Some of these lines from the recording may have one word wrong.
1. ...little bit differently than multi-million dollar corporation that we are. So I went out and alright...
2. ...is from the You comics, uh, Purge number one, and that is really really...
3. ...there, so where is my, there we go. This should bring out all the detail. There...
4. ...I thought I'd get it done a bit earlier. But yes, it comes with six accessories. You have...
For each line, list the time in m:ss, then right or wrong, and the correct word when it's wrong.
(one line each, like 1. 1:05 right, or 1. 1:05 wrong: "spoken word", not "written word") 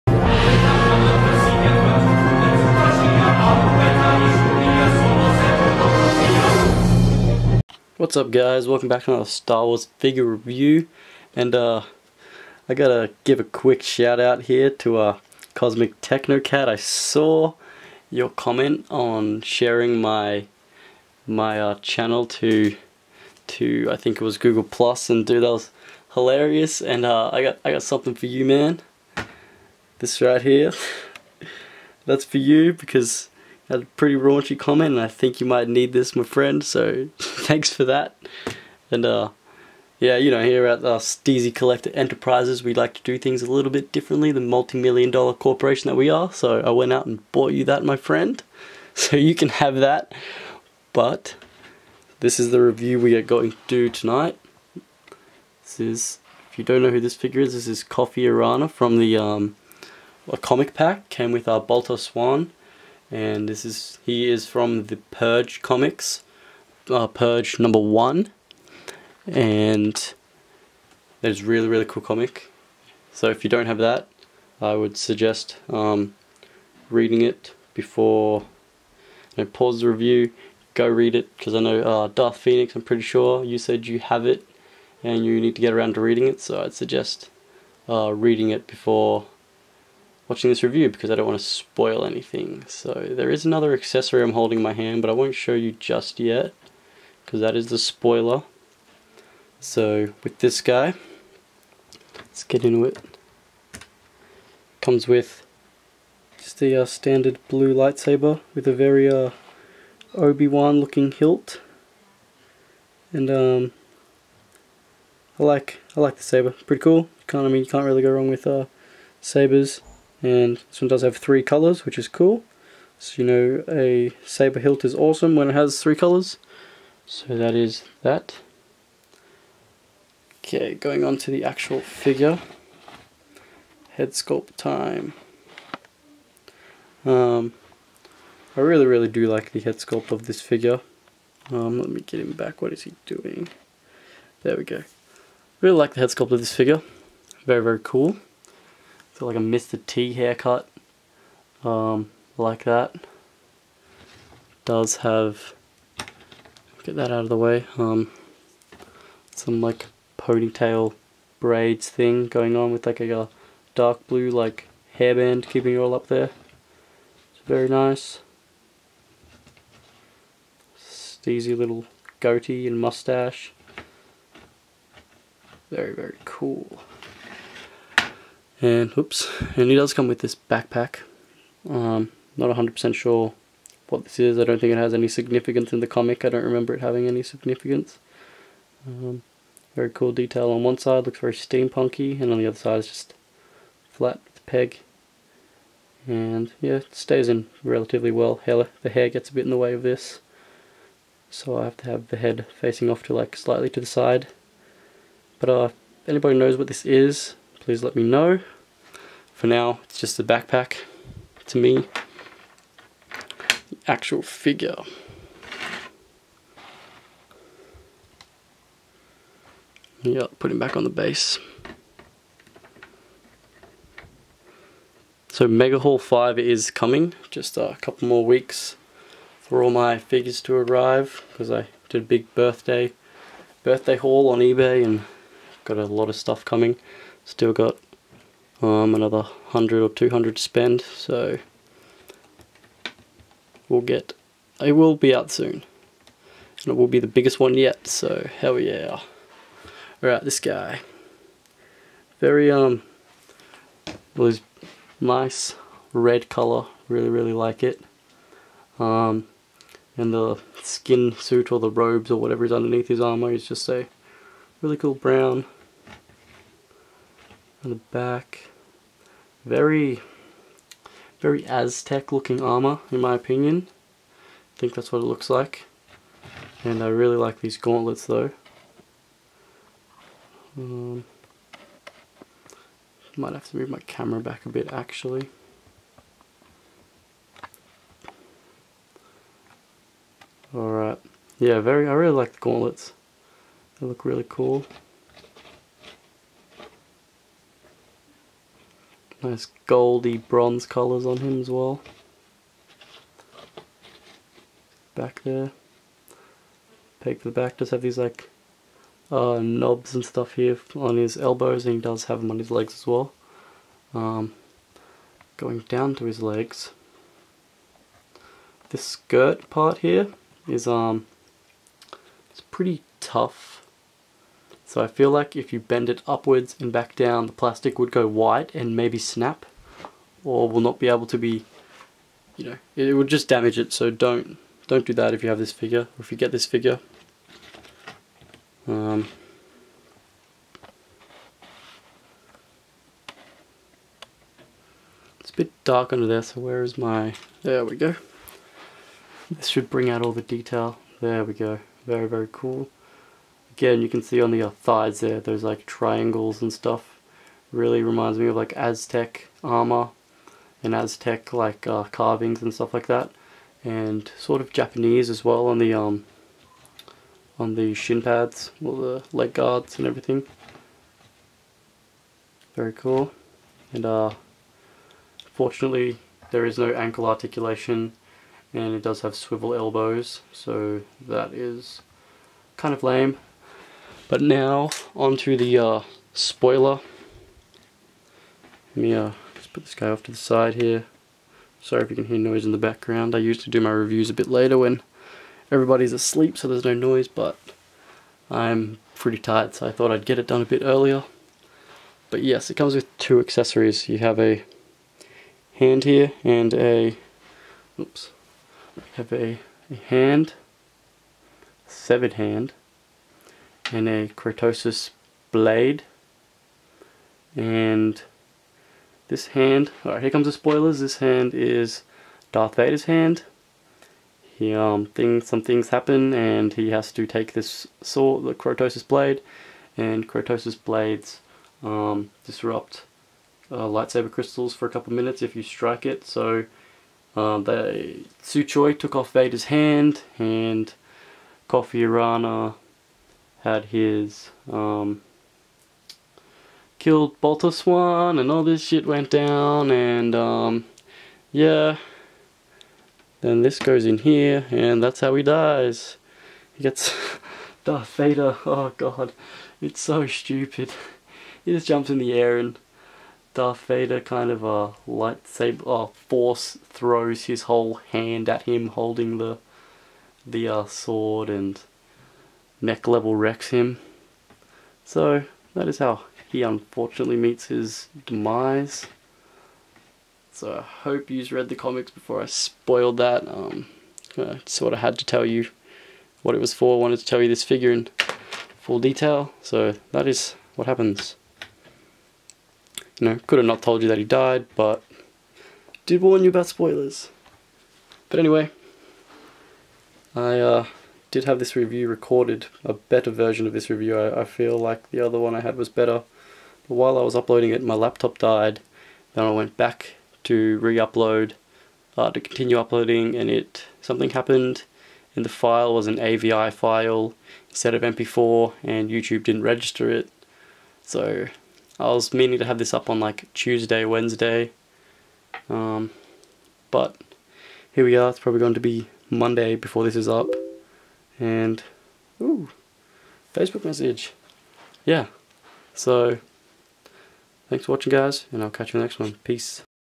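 1. 0:43 wrong: "bought", not "alright"
2. 1:04 wrong: "Purge", not "You"
3. 5:46 right
4. 6:39 wrong: "two", not "six".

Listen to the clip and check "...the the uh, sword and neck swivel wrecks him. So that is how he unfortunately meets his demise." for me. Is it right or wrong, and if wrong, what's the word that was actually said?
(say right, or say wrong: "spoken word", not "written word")
wrong: "level", not "swivel".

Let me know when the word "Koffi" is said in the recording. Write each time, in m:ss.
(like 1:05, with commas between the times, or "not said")
0:57, 7:21.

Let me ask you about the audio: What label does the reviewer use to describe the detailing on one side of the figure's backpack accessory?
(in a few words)
steampunky.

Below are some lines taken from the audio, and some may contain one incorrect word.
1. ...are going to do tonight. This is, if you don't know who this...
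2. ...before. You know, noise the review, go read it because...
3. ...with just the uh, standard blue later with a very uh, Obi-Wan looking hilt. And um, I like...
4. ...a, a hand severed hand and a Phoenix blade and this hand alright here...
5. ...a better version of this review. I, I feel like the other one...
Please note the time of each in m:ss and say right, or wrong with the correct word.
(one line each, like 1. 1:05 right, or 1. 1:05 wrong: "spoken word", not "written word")
1. 0:53 right
2. 1:17 wrong: "pause", not "noise"
3. 1:45 wrong: "lightsaber", not "later"
4. 6:49 wrong: "Cortosis", not "Phoenix"
5. 8:22 right.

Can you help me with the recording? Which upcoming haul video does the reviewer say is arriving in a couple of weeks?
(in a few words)
Mega Haul 5.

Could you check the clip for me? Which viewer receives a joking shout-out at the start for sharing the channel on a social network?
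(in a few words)
Cosmic Technocat.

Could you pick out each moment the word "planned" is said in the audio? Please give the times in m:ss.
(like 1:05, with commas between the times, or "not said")
not said.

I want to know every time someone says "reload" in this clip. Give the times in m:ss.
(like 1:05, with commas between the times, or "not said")
not said.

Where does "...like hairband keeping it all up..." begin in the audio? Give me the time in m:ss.
2:44.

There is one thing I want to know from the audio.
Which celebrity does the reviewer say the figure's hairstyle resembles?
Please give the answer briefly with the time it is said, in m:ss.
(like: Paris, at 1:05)
Mr. T, at 2:29.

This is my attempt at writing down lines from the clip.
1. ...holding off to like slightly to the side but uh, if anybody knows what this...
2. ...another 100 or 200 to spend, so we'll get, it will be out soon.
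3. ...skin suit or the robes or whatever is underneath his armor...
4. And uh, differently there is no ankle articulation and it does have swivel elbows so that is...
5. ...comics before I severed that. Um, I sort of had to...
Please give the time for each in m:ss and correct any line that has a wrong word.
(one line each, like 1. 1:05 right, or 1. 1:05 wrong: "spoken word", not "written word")
1. 3:22 wrong: "facing", not "holding"
2. 3:58 right
3. 4:20 right
4. 6:13 wrong: "fortunately", not "differently"
5. 8:01 wrong: "spoiled", not "severed".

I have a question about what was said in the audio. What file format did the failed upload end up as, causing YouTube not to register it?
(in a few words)
AVI.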